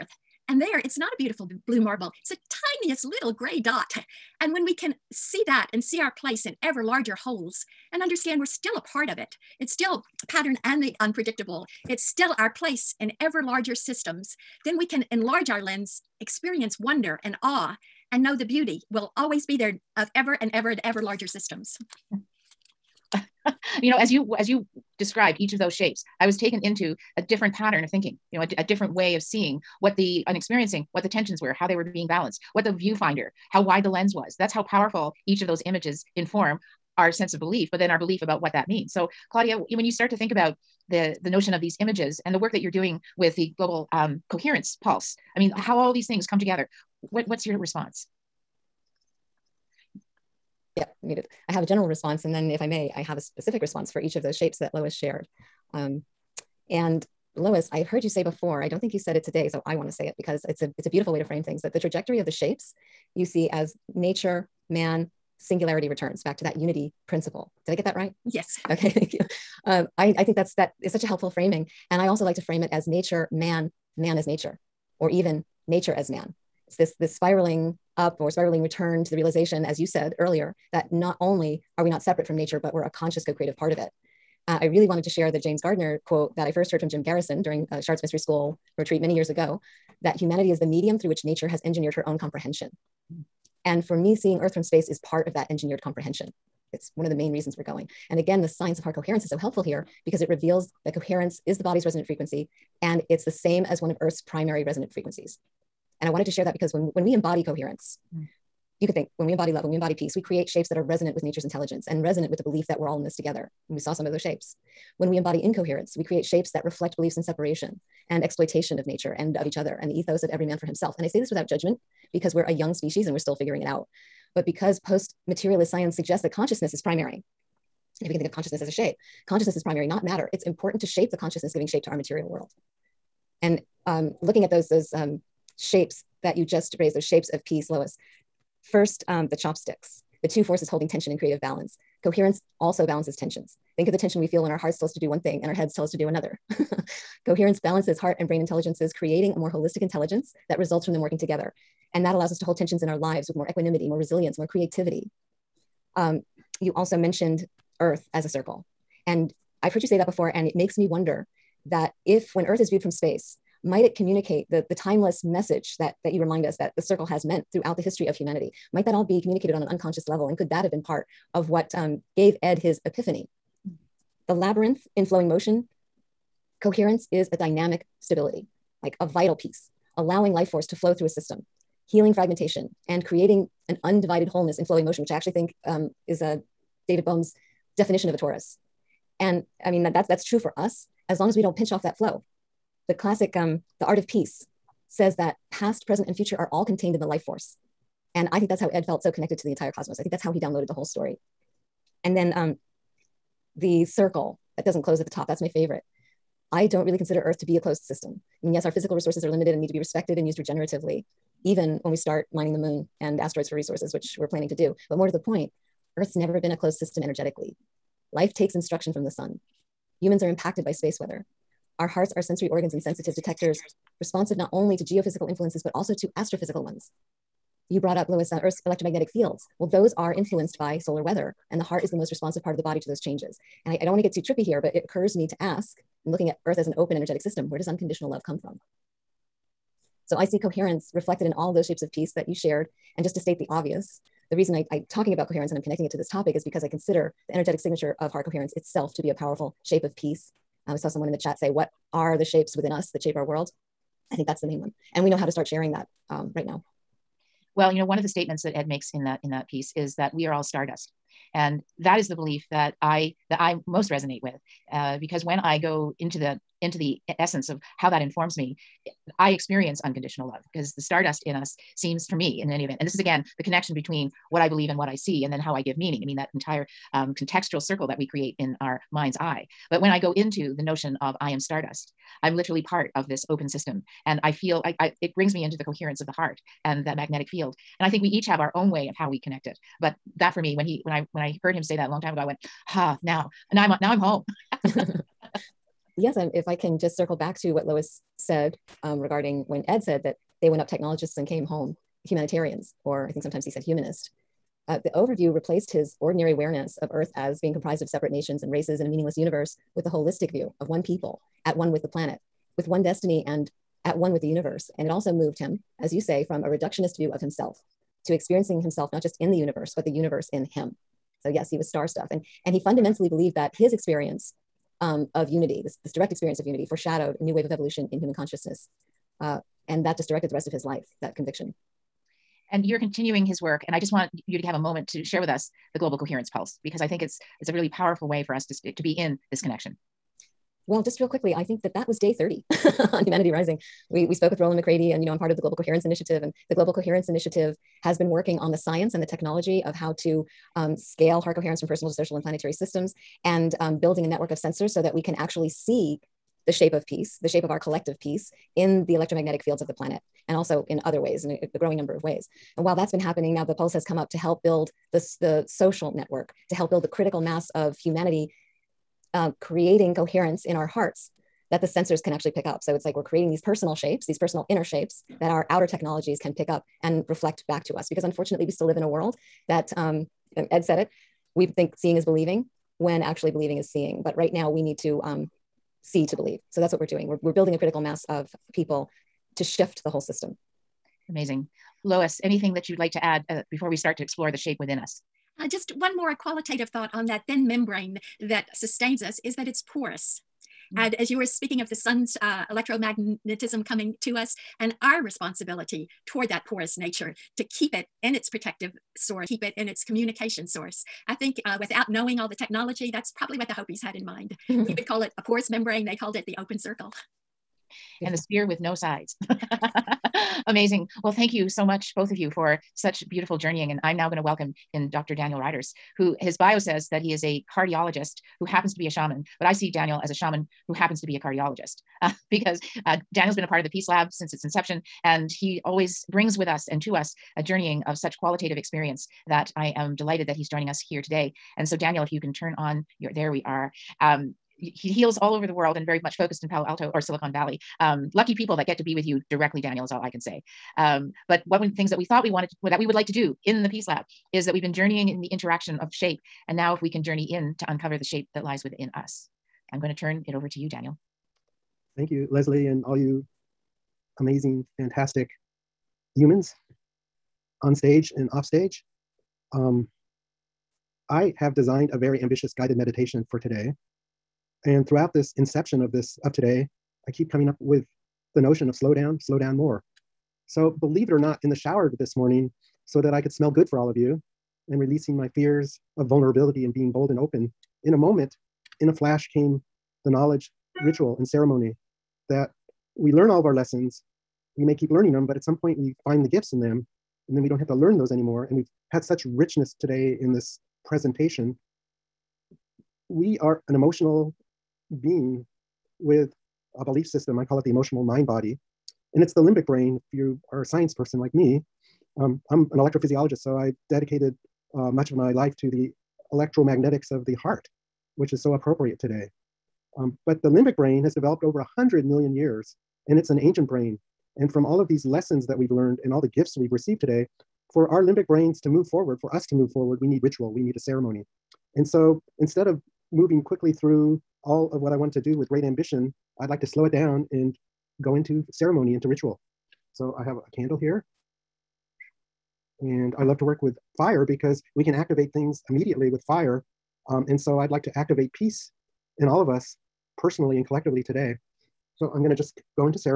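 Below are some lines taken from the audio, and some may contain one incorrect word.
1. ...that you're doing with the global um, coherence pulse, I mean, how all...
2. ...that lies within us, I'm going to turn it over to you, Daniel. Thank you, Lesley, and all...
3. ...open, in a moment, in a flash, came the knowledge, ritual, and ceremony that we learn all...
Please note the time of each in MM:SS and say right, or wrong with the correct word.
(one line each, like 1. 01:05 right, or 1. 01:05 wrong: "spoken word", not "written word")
1. 00:42 right
2. 07:38 right
3. 08:07 right.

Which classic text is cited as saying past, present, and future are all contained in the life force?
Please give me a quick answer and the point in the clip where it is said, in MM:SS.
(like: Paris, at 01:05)
The Art of Peace, at 03:13.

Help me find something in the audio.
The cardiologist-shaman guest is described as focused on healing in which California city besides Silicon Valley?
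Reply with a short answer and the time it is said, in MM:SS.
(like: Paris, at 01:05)
Palo Alto, at 07:26.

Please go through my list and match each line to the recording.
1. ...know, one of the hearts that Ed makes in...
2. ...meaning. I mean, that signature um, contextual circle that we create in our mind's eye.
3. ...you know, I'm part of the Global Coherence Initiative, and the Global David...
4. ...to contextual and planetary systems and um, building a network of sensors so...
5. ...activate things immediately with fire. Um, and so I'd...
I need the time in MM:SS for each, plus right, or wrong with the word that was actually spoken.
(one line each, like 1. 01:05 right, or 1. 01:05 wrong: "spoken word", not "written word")
1. 04:17 wrong: "statements", not "hearts"
2. 04:35 wrong: "entire", not "signature"
3. 05:45 wrong: "Coherence", not "David"
4. 05:51 wrong: "social", not "contextual"
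5. 09:04 right.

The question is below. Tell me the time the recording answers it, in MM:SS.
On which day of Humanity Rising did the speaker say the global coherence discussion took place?
05:41.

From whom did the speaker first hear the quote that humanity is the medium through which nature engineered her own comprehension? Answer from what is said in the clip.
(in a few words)
Jim Garrison.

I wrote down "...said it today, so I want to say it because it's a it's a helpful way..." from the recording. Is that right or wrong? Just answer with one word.
wrong.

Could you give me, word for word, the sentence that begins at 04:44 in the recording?
And I feel I, I it brings me into the coherence of the heart and that magnetic field.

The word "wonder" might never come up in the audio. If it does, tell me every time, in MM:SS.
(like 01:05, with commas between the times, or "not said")
00:16, 02:40.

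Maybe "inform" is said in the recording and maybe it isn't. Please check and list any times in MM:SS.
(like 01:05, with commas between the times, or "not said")
00:36, 04:28.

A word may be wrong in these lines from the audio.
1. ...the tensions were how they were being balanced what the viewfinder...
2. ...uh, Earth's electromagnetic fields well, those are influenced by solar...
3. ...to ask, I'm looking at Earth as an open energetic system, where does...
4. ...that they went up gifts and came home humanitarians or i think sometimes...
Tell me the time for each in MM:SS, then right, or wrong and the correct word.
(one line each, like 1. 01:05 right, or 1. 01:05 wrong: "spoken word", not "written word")
1. 00:31 right
2. 03:48 right
3. 03:55 right
4. 05:00 wrong: "technologists", not "gifts".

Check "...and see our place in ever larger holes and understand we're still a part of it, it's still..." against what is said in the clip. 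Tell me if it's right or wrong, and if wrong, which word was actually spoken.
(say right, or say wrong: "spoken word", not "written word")
right.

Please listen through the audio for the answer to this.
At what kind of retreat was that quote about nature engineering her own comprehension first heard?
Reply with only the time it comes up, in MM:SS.
01:27.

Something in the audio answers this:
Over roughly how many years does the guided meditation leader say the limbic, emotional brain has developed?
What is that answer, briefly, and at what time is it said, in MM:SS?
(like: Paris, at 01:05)
100 million years, at 08:41.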